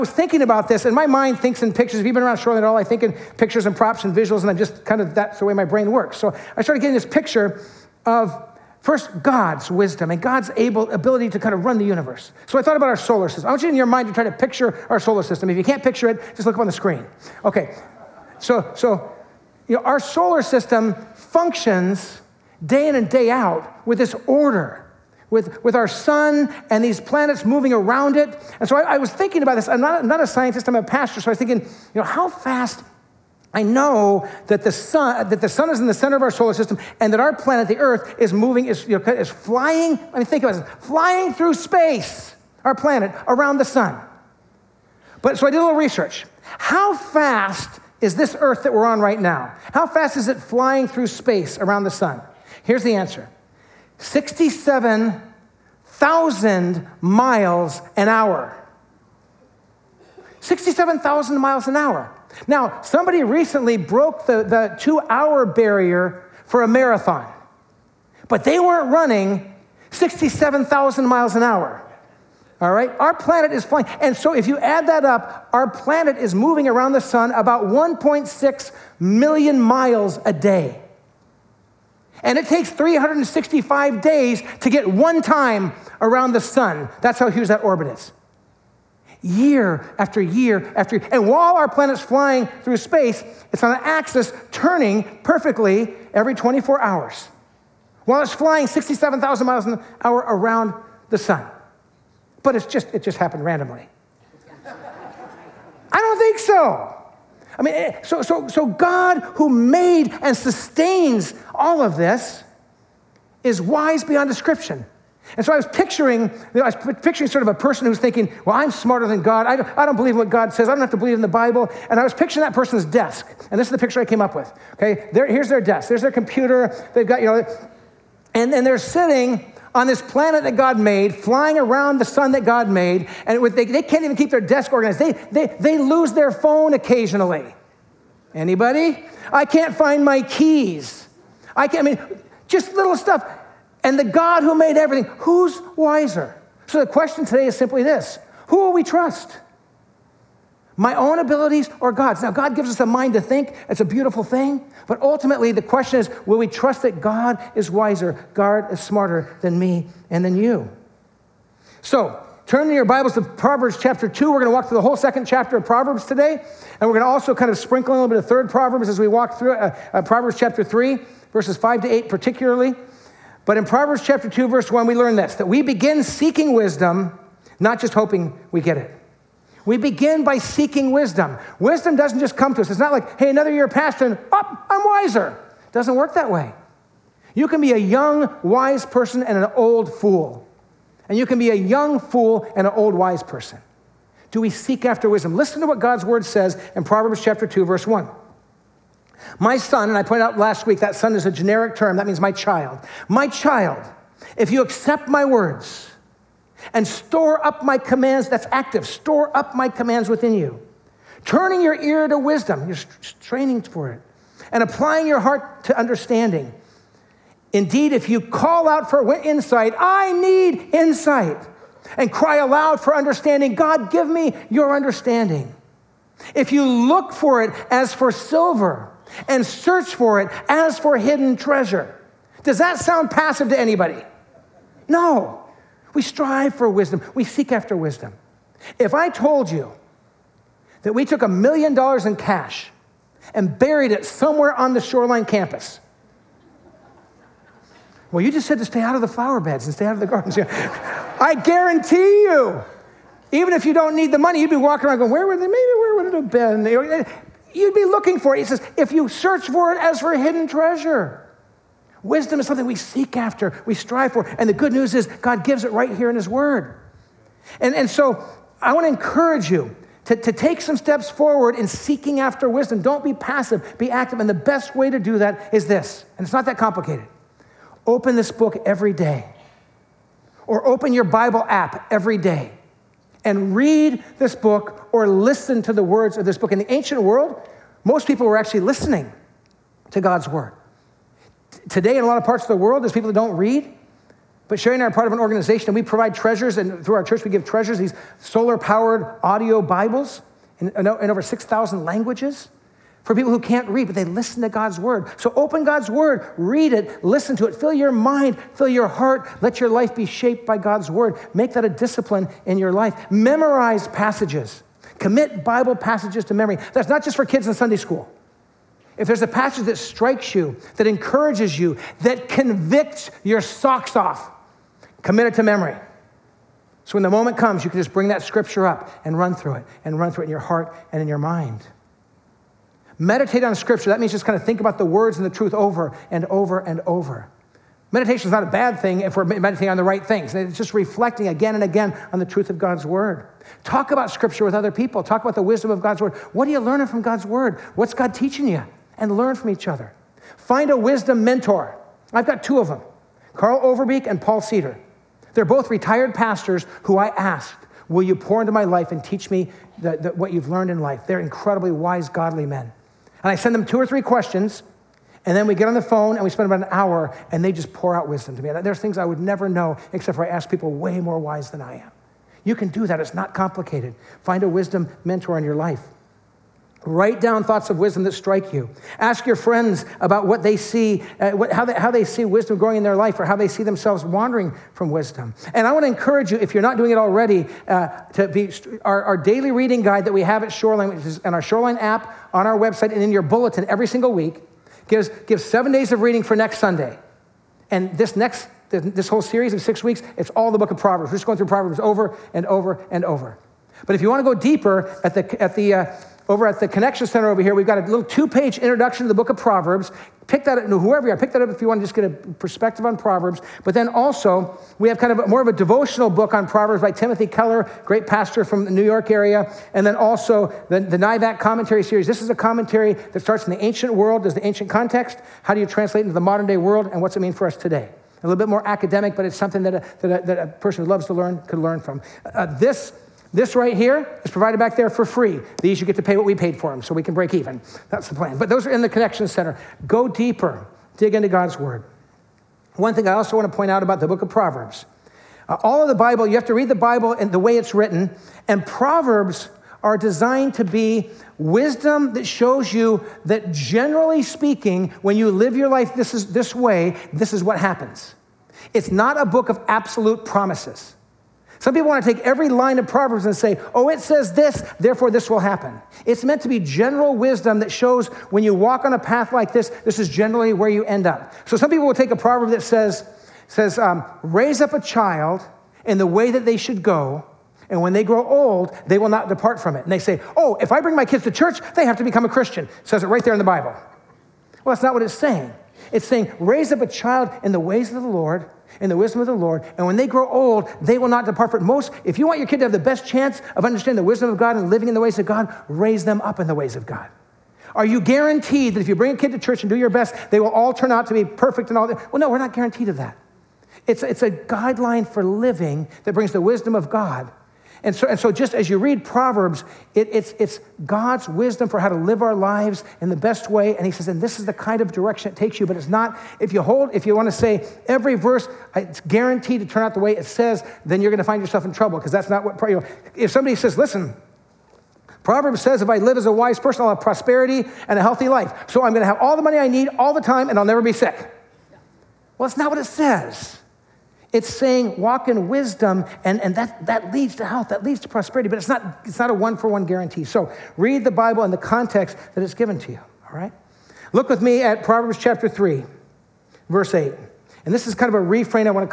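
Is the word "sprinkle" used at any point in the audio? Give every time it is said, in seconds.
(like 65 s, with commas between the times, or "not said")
167 s.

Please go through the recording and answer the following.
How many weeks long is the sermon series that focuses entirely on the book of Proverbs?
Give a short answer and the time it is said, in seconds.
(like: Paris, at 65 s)
6, at 399 s.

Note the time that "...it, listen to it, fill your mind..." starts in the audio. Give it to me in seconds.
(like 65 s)
306 s.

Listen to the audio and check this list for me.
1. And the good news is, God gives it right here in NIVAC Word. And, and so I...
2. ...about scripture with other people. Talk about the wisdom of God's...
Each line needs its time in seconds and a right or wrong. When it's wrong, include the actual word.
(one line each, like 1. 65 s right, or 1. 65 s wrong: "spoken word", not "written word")
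1. 264 s wrong: "His", not "NIVAC"
2. 343 s right.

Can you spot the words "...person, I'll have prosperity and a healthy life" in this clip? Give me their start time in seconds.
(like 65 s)
526 s.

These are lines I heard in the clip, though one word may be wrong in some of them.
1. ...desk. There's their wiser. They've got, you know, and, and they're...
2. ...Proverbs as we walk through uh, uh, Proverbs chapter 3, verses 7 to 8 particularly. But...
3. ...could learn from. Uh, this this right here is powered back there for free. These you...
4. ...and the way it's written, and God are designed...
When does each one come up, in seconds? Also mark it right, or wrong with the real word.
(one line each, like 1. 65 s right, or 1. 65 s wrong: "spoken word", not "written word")
1. 125 s wrong: "computer", not "wiser"
2. 168 s wrong: "5", not "7"
3. 431 s wrong: "provided", not "powered"
4. 447 s wrong: "Proverbs", not "God".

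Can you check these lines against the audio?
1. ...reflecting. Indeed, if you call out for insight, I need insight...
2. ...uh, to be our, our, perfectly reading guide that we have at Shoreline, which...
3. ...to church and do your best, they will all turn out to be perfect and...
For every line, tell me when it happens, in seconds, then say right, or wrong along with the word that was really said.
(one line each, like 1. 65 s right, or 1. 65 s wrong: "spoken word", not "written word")
1. 215 s wrong: "understanding", not "reflecting"
2. 387 s wrong: "daily", not "perfectly"
3. 499 s right.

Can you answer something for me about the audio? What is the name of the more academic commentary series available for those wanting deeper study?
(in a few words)
NIVAC.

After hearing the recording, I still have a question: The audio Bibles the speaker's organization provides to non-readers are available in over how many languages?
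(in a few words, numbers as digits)
6,000.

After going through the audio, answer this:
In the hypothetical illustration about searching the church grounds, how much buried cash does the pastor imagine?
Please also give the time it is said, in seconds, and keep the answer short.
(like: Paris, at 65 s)
a million dollars, at 241 s.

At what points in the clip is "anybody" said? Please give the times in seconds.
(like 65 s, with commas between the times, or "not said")
138 s, 233 s.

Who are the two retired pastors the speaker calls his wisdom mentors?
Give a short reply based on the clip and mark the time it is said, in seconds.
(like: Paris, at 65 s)
Carl Overbeek, at 353 s.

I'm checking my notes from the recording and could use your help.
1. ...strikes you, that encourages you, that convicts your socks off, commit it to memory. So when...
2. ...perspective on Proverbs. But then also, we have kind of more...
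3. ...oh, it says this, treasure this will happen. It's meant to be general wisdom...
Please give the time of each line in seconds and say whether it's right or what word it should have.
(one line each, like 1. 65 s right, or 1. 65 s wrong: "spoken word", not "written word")
1. 319 s right
2. 412 s right
3. 463 s wrong: "therefore", not "treasure".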